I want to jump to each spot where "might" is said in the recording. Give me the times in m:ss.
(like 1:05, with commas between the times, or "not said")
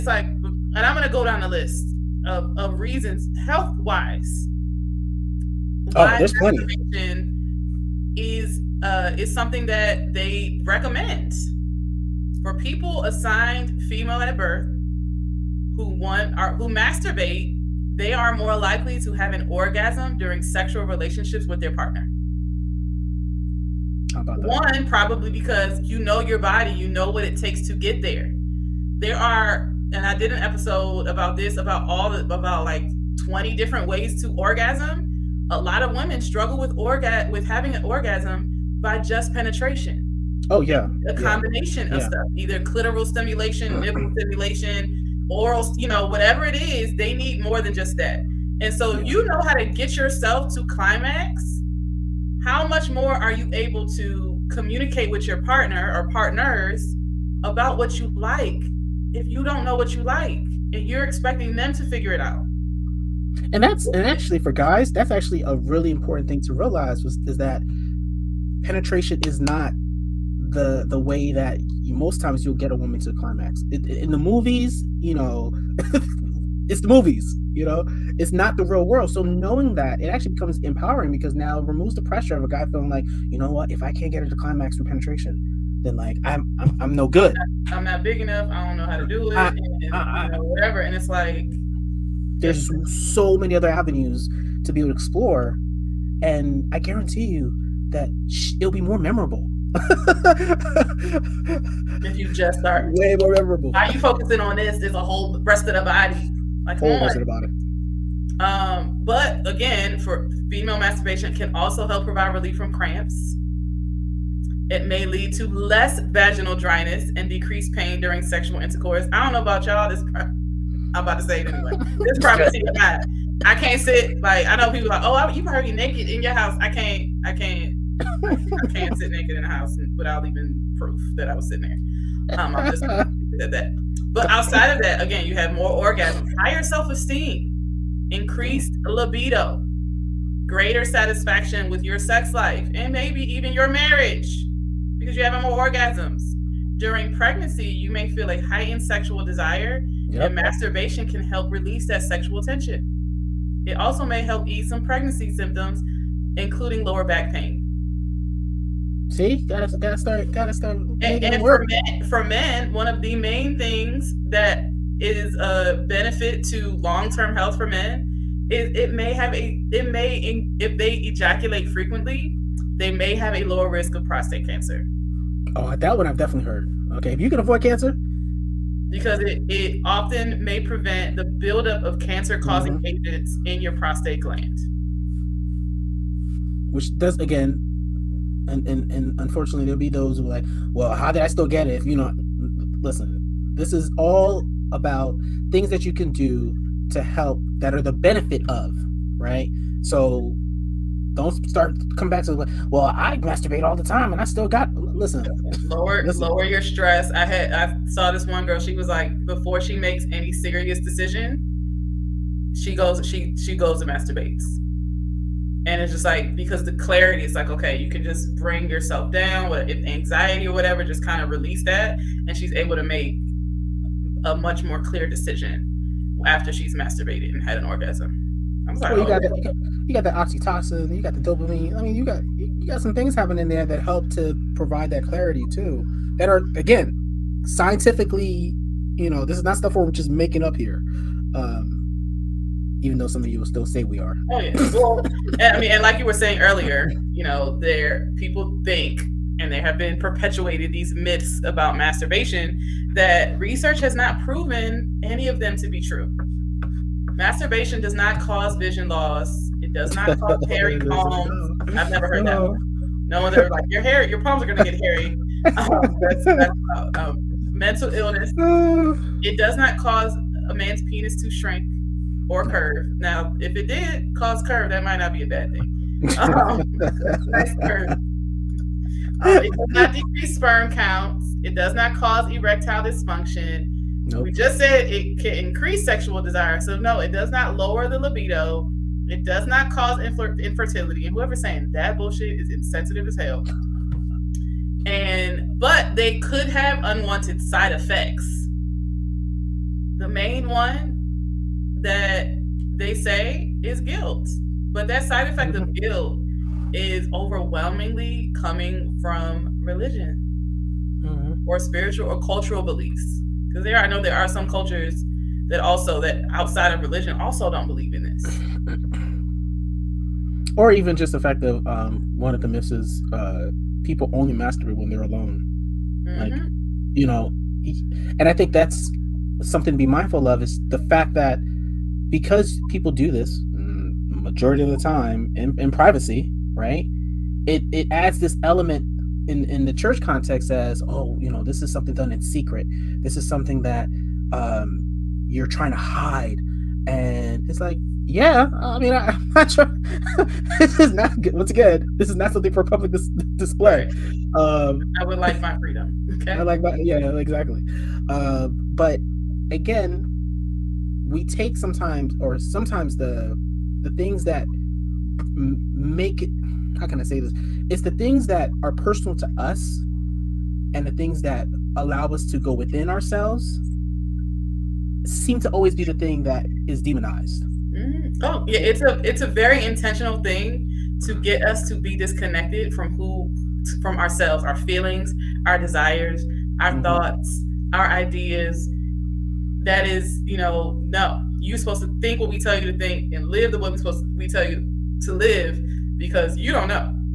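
4:34.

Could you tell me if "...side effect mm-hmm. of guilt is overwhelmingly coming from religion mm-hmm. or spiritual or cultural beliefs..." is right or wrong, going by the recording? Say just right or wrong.
right.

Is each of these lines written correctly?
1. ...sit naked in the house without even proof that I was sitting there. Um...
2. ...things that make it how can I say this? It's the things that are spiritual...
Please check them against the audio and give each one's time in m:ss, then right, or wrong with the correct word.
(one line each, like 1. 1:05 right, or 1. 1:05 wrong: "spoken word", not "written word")
1. 2:08 right
2. 6:03 wrong: "personal", not "spiritual".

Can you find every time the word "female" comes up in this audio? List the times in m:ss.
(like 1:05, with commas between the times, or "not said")
0:13, 1:50.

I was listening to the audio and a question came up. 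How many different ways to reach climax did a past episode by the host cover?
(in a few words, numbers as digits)
20.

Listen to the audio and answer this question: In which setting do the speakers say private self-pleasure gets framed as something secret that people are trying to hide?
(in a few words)
Church.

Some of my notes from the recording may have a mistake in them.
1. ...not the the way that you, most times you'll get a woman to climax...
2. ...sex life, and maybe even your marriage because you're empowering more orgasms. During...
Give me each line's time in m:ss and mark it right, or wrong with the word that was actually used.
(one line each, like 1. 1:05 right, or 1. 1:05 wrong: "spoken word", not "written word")
1. 1:09 right
2. 2:21 wrong: "having", not "empowering".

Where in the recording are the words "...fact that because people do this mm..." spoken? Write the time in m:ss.
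5:30.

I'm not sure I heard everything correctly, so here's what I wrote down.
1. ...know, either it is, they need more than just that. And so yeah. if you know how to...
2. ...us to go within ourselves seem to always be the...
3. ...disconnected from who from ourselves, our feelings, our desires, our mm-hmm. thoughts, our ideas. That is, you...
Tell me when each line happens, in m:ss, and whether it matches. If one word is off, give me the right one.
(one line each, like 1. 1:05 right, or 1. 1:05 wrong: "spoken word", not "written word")
1. 0:45 wrong: "whatever", not "either"
2. 6:12 right
3. 6:21 right.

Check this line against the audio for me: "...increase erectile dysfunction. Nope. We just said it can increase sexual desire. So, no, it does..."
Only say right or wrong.
wrong.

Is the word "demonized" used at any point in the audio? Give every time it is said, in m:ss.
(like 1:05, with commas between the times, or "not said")
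6:16.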